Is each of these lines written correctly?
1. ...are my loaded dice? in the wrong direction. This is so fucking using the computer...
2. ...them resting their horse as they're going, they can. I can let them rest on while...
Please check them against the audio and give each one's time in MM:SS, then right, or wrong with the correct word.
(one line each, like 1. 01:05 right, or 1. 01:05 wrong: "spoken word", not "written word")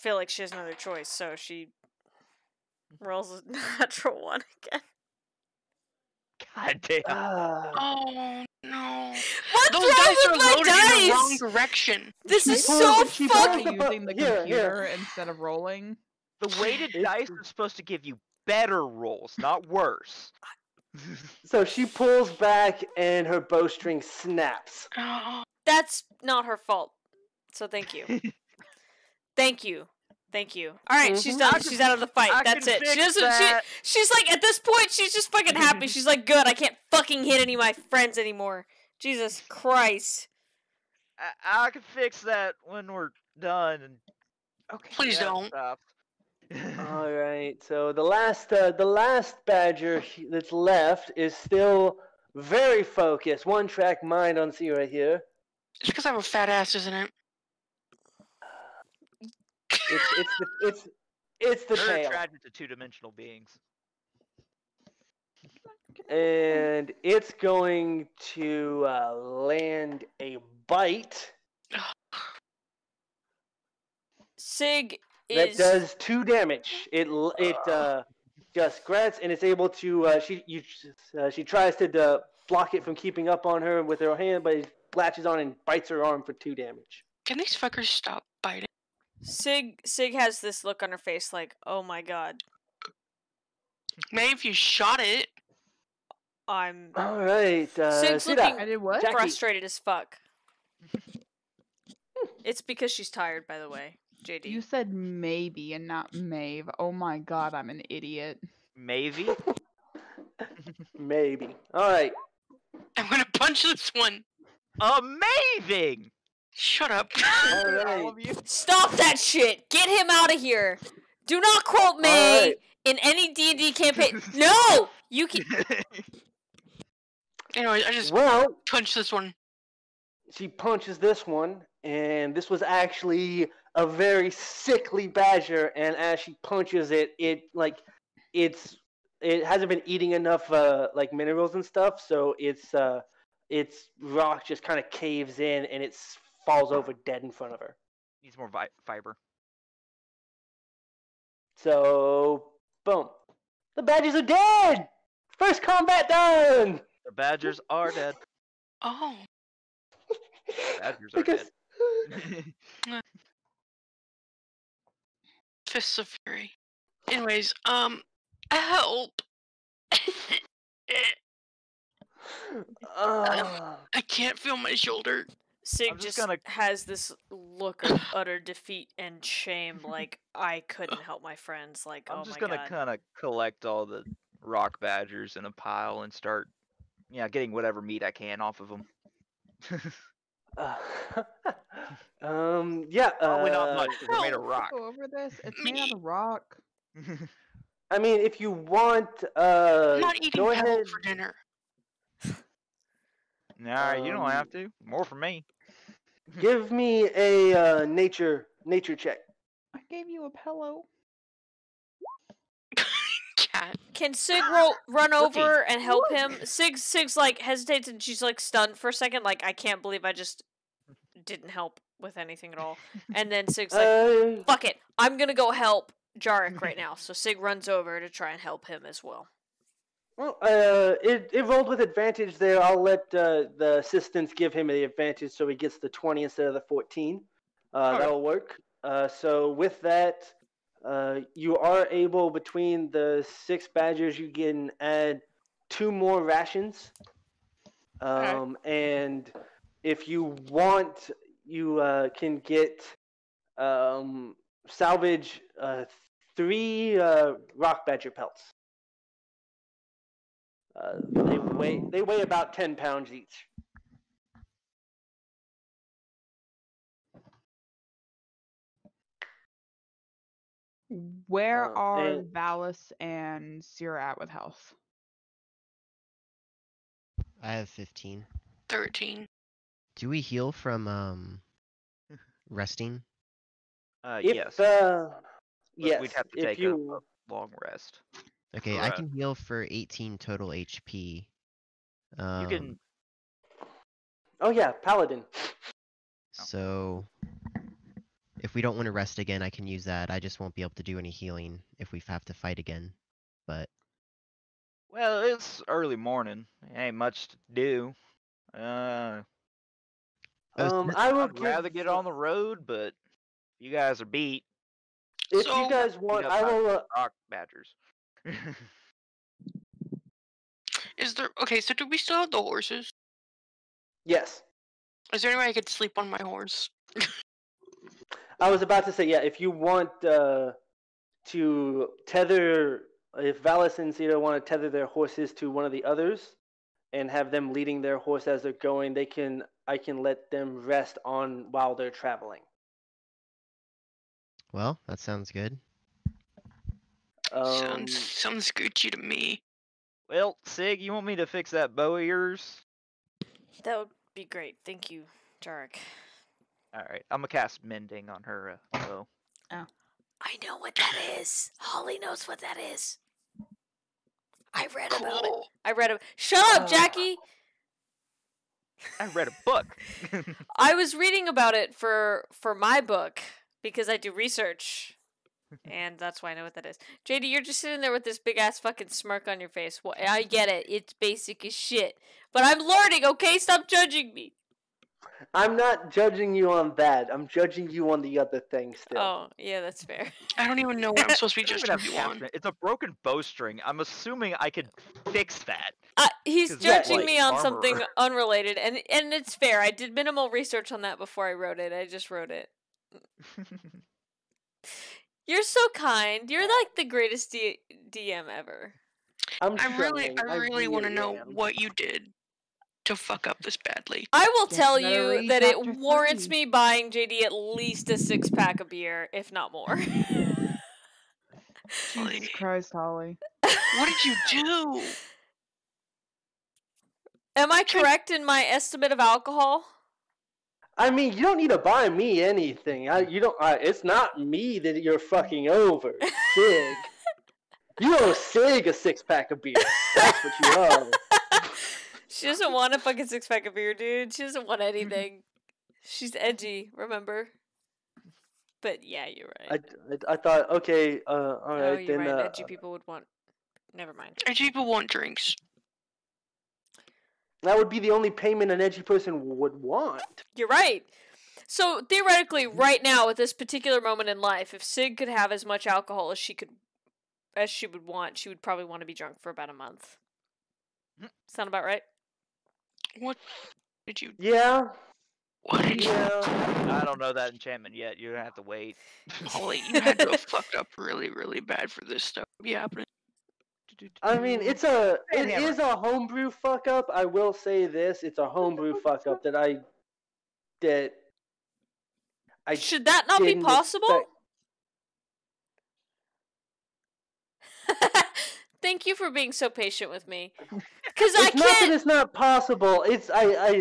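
1. 00:10 right
2. 05:37 wrong: "leading", not "resting".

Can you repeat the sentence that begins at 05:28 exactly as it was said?
I was about to say yeah.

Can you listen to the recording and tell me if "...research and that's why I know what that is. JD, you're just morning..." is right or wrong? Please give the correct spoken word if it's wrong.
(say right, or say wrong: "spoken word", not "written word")
wrong: "sitting", not "morning".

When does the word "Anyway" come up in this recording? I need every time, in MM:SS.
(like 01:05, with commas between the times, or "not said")
02:07, 02:47.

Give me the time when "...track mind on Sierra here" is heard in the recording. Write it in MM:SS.
00:53.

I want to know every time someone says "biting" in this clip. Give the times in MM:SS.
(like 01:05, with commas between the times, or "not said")
01:28.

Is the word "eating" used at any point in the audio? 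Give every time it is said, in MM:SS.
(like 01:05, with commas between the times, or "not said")
02:19, 03:20.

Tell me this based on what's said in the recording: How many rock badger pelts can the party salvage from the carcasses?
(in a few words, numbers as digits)
3.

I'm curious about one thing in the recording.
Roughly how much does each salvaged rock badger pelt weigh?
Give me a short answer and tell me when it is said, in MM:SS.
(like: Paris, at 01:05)
10 pounds, at 04:22.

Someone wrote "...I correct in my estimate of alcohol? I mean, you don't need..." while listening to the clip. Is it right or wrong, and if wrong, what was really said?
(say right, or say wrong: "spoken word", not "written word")
right.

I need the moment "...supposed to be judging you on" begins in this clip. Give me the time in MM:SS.
06:31.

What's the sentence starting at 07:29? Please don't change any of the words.
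I, I, I thought okay, uh, all oh, right.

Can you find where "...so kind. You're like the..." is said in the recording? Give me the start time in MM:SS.
06:45.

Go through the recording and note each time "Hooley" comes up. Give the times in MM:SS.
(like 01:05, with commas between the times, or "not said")
06:01, 07:02, 07:59.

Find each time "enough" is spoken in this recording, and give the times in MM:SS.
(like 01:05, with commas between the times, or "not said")
02:20.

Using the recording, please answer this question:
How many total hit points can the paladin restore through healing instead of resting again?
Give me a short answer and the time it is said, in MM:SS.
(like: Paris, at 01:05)
18, at 04:49.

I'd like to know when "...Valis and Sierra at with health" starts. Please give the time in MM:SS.
04:32.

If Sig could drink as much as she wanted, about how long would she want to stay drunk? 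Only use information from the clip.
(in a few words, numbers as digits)
About a month.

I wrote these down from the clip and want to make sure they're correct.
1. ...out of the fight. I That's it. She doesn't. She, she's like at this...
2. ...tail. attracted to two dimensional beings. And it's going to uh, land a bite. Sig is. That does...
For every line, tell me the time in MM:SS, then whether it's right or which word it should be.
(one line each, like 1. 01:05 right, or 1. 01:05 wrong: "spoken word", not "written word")
1. 00:31 right
2. 01:01 right.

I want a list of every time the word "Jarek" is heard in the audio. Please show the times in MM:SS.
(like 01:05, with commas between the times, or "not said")
03:46, 05:55.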